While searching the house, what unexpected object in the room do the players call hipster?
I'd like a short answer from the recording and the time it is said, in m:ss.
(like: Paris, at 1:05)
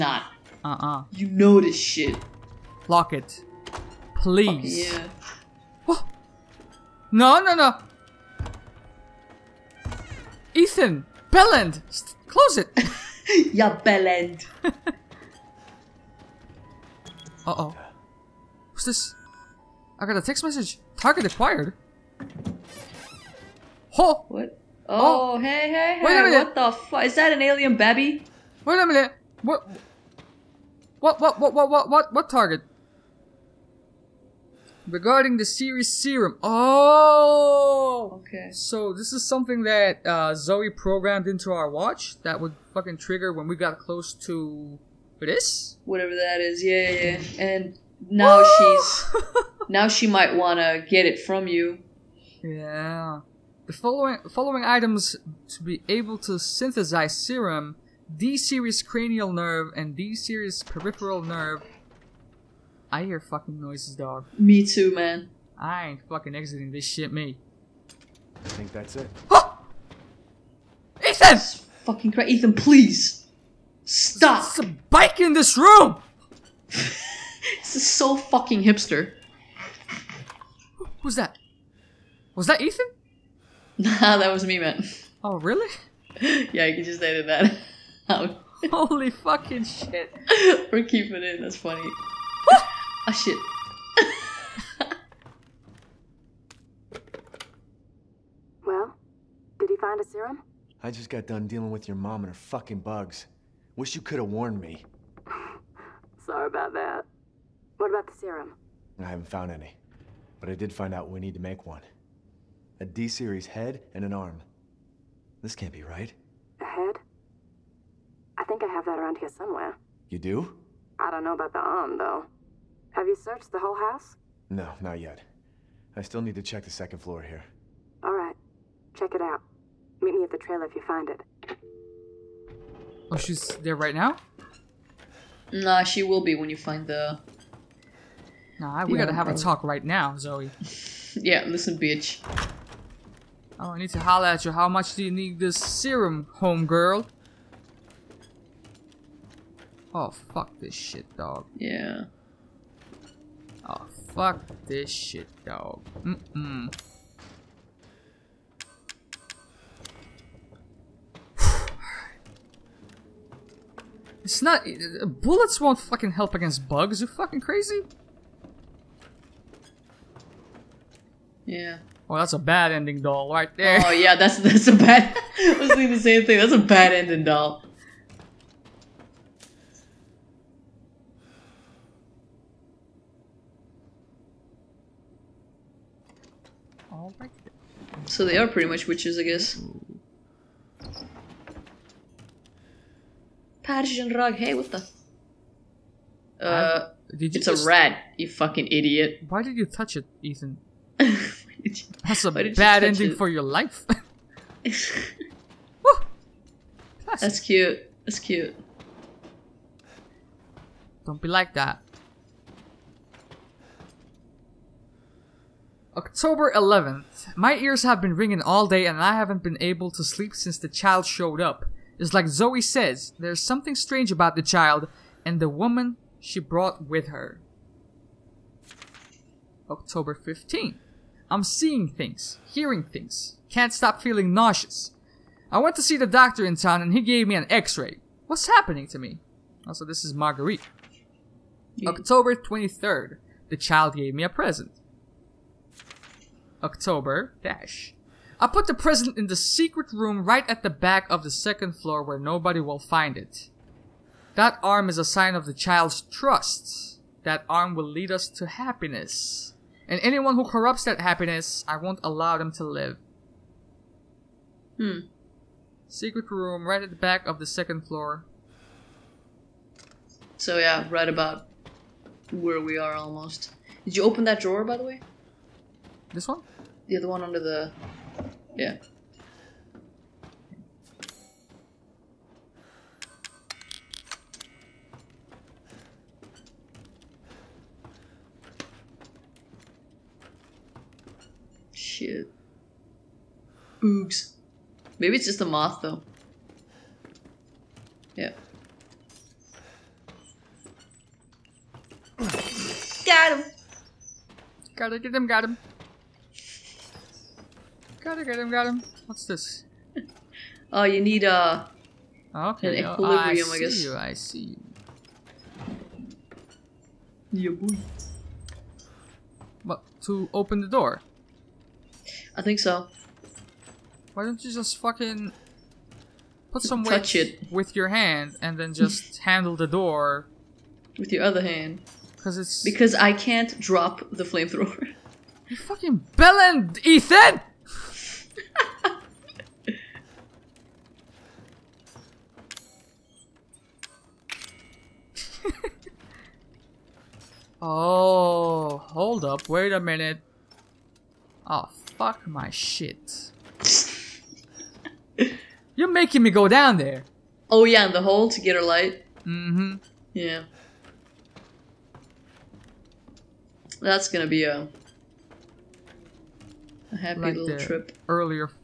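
A bike, at 1:14.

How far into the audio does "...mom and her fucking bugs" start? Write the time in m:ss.
1:41.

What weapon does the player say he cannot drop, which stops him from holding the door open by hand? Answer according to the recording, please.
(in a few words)
Flamethrower.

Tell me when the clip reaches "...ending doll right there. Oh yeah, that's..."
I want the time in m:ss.
2:52.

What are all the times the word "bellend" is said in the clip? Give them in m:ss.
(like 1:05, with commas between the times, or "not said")
0:11, 5:36.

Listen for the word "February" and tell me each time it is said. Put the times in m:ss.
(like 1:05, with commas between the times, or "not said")
not said.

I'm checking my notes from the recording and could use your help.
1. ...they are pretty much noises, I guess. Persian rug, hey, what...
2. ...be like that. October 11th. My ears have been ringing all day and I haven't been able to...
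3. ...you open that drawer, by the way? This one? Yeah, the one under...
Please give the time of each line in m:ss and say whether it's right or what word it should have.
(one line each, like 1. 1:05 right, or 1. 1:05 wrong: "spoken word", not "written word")
1. 3:08 wrong: "witches", not "noises"
2. 3:31 right
3. 4:33 right.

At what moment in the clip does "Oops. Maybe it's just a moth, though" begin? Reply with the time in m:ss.
4:53.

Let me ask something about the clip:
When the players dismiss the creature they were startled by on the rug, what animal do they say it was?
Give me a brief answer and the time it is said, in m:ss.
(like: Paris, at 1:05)
A rat, at 3:17.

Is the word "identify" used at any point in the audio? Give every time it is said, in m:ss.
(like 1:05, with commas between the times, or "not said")
not said.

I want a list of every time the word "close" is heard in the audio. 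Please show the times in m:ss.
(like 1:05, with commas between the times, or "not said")
0:12, 0:43.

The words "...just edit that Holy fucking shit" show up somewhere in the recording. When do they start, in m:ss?
1:26.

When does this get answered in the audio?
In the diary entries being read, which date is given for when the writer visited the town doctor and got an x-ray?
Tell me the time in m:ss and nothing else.
3:49.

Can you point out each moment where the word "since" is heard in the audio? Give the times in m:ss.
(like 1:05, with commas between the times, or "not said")
3:40.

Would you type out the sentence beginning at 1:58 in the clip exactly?
I think I have that around here somewhere.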